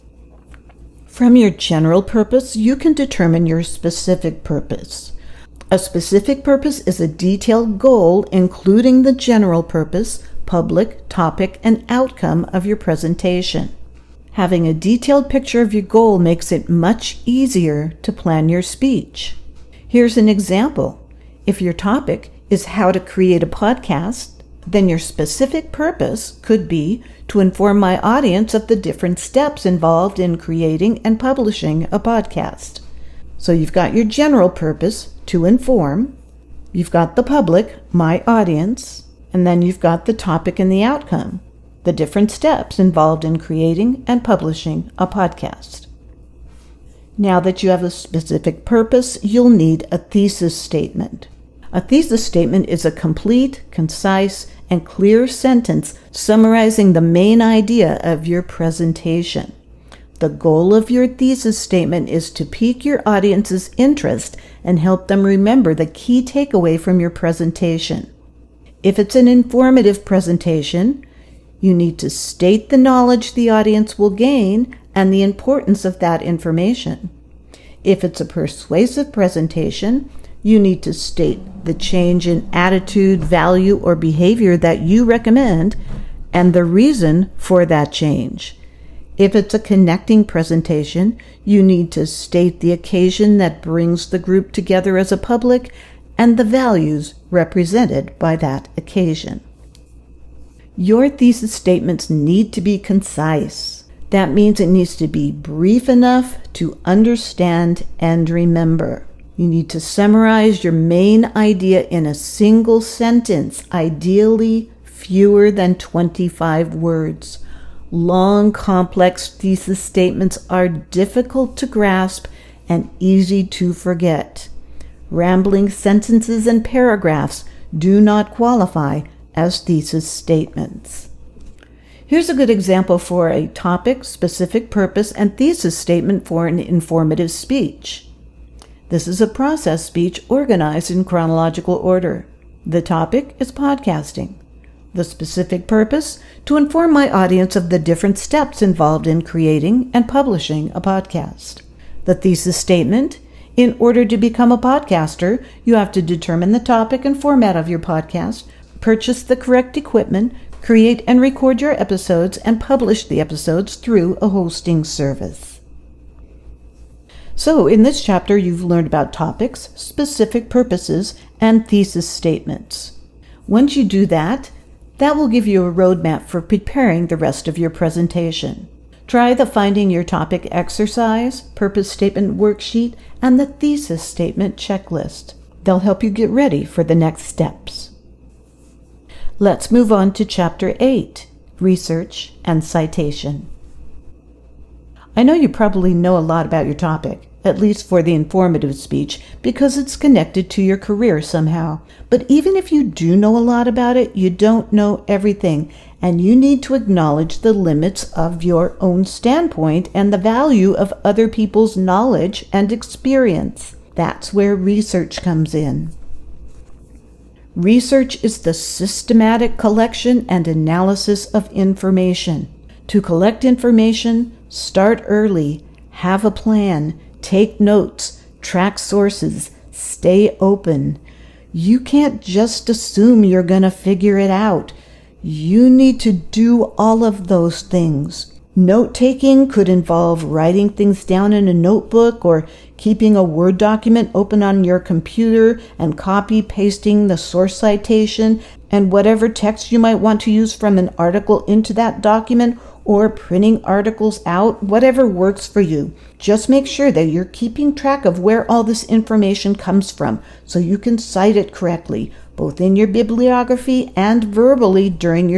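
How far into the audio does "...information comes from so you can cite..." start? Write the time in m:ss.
4:18.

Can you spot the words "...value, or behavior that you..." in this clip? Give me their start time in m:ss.
1:23.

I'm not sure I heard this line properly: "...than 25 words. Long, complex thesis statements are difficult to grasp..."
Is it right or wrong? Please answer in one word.
right.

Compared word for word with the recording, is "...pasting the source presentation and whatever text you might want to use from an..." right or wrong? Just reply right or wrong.
wrong.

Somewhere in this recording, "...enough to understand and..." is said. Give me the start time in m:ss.
1:45.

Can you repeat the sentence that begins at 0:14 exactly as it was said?
Having a detailed picture of your goal makes it much easier to plan your speech.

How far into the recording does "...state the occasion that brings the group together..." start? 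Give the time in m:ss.
1:32.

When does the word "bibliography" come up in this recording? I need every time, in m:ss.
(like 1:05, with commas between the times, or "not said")
4:22.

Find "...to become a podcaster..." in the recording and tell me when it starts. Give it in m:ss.
2:34.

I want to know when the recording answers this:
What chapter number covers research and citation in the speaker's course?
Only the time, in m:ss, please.
3:10.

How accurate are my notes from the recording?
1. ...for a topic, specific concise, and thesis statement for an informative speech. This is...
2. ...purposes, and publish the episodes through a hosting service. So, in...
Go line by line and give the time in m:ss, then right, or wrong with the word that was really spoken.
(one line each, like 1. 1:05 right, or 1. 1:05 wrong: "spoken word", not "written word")
1. 2:12 wrong: "purpose", not "concise"
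2. 2:41 wrong: "episodes", not "purposes".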